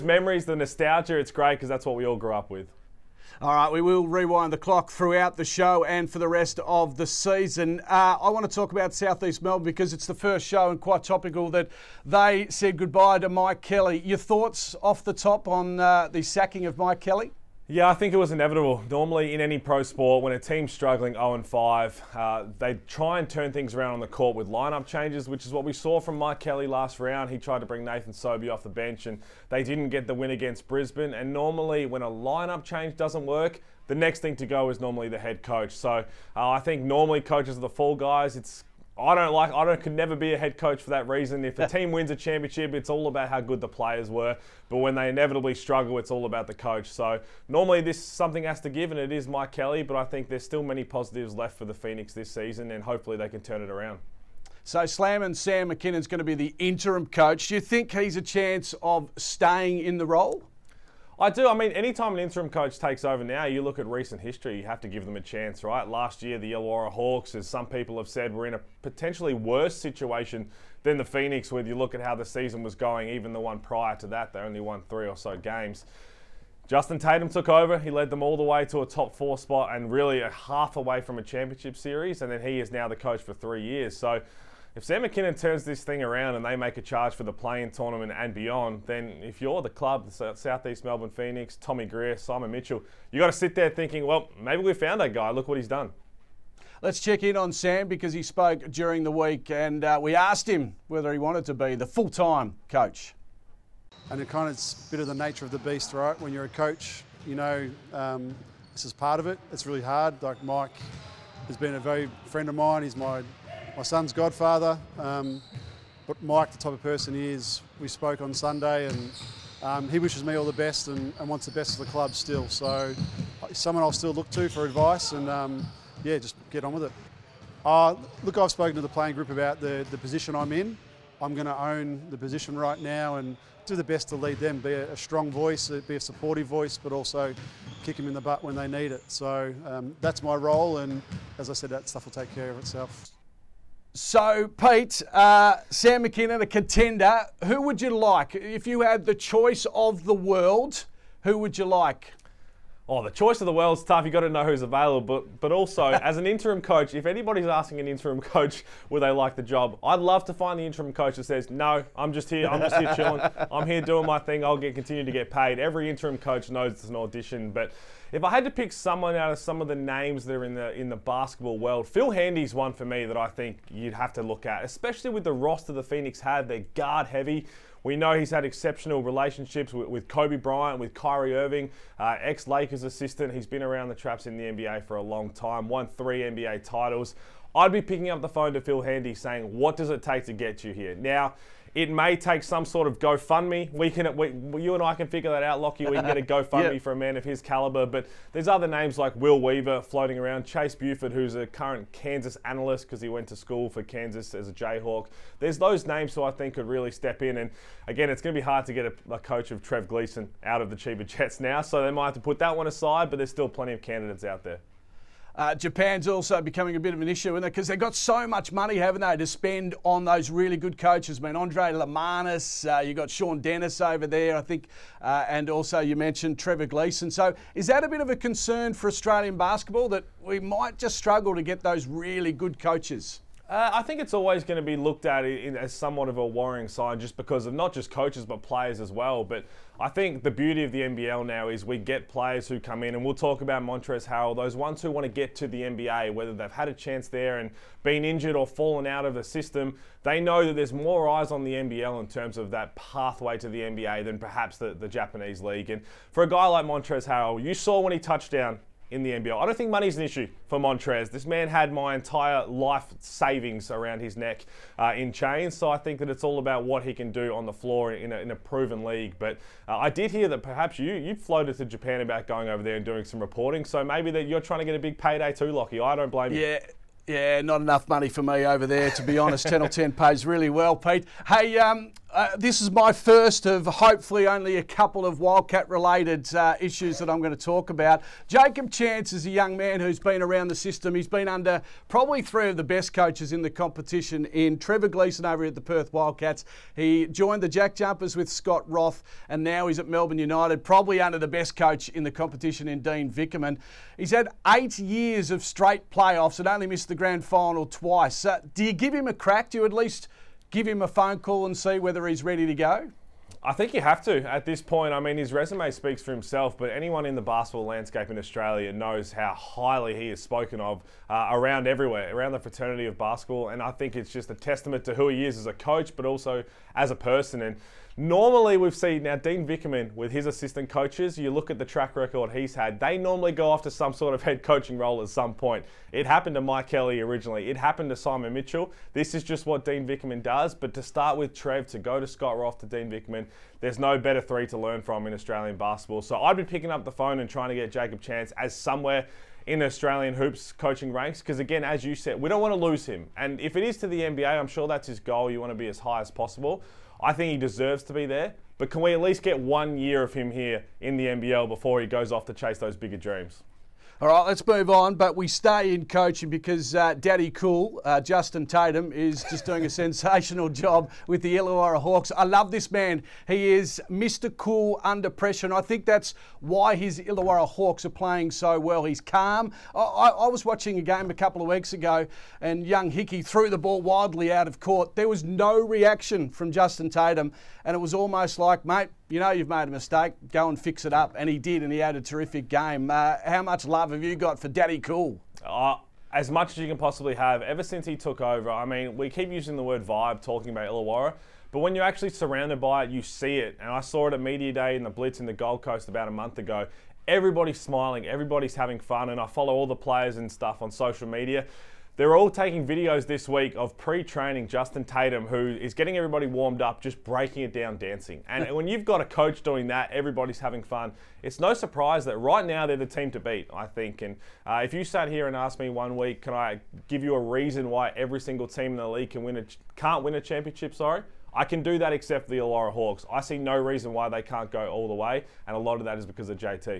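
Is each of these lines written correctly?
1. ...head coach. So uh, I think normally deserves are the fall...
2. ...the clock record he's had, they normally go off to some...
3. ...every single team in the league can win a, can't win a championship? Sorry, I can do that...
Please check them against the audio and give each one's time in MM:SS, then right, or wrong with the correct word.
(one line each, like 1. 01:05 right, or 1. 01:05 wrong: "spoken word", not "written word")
1. 00:35 wrong: "coaches", not "deserves"
2. 05:31 wrong: "track", not "clock"
3. 07:07 right.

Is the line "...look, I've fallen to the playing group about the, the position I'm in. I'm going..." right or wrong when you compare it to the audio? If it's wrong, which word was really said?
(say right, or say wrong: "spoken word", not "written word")
wrong: "spoken", not "fallen".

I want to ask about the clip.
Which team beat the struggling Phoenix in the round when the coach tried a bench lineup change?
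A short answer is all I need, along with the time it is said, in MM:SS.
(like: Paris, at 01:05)
Brisbane, at 00:30.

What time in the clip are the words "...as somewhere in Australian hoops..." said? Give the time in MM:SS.
05:48.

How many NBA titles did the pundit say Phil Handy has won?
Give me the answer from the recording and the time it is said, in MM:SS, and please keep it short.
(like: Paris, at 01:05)
3, at 03:05.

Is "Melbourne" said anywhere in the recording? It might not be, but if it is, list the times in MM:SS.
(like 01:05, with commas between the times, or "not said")
00:09, 01:30, 04:59.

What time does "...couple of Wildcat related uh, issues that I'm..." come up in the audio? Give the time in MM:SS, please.
04:44.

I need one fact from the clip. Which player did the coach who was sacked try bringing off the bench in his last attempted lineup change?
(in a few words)
Nathan Sobey.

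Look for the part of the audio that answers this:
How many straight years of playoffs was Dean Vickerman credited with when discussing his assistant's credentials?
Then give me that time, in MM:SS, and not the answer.
05:04.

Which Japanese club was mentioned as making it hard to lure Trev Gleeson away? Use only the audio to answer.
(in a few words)
Chiba Jets.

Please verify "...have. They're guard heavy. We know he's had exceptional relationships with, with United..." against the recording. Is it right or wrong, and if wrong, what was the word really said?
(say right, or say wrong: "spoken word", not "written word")
wrong: "Kobe", not "United".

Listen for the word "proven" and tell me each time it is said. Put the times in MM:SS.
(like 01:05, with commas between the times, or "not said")
04:28.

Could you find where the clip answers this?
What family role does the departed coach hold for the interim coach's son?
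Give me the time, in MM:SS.
01:54.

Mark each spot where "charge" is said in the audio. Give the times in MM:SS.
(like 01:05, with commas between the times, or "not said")
01:26.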